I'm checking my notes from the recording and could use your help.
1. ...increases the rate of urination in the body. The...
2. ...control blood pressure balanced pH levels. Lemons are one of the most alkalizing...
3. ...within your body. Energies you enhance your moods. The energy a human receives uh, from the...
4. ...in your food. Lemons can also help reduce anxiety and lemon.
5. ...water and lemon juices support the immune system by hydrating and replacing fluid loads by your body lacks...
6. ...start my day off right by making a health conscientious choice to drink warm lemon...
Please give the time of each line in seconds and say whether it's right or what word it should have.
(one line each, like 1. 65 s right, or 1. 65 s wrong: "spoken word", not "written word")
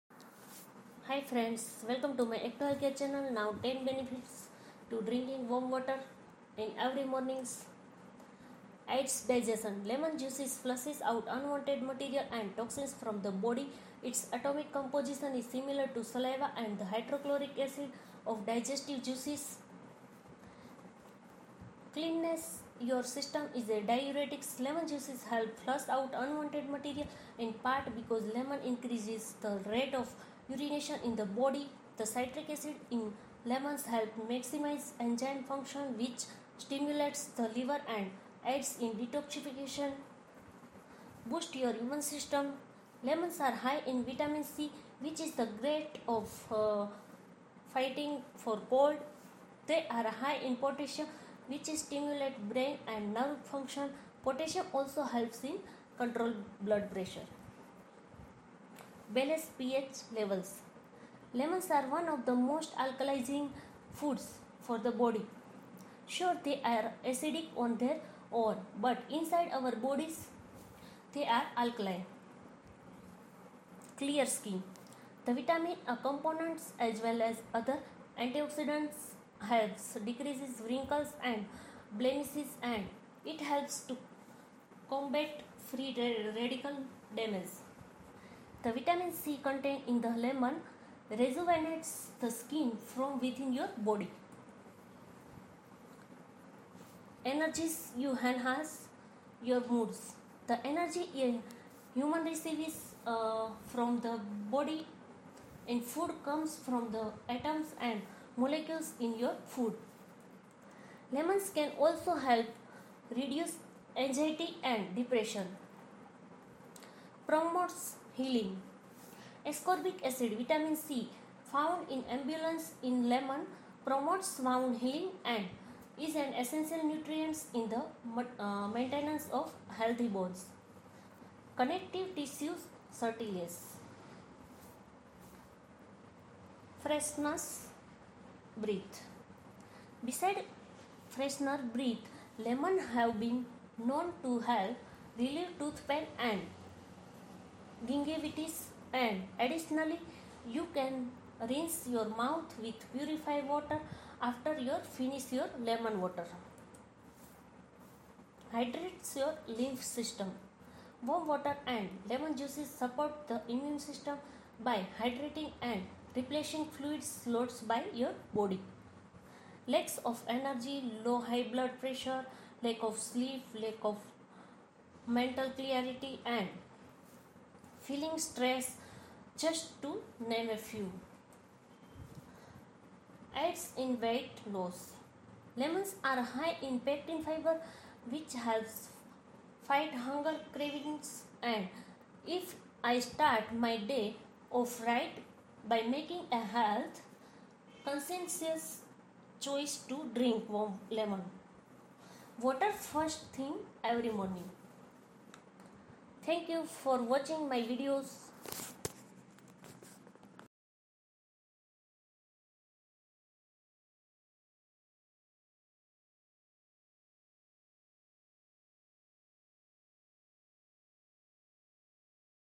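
1. 28 s right
2. 55 s right
3. 93 s right
4. 108 s wrong: "depression", not "lemon"
5. 161 s right
6. 192 s right.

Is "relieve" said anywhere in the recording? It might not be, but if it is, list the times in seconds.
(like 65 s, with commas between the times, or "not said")
145 s.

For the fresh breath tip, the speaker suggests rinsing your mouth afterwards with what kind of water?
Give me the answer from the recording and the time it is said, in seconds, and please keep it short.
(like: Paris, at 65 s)
purified water, at 152 s.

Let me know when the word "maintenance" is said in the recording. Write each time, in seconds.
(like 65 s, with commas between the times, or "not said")
128 s.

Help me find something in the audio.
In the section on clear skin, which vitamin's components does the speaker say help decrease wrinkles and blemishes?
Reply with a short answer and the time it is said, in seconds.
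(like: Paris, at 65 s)
vitamin A, at 75 s.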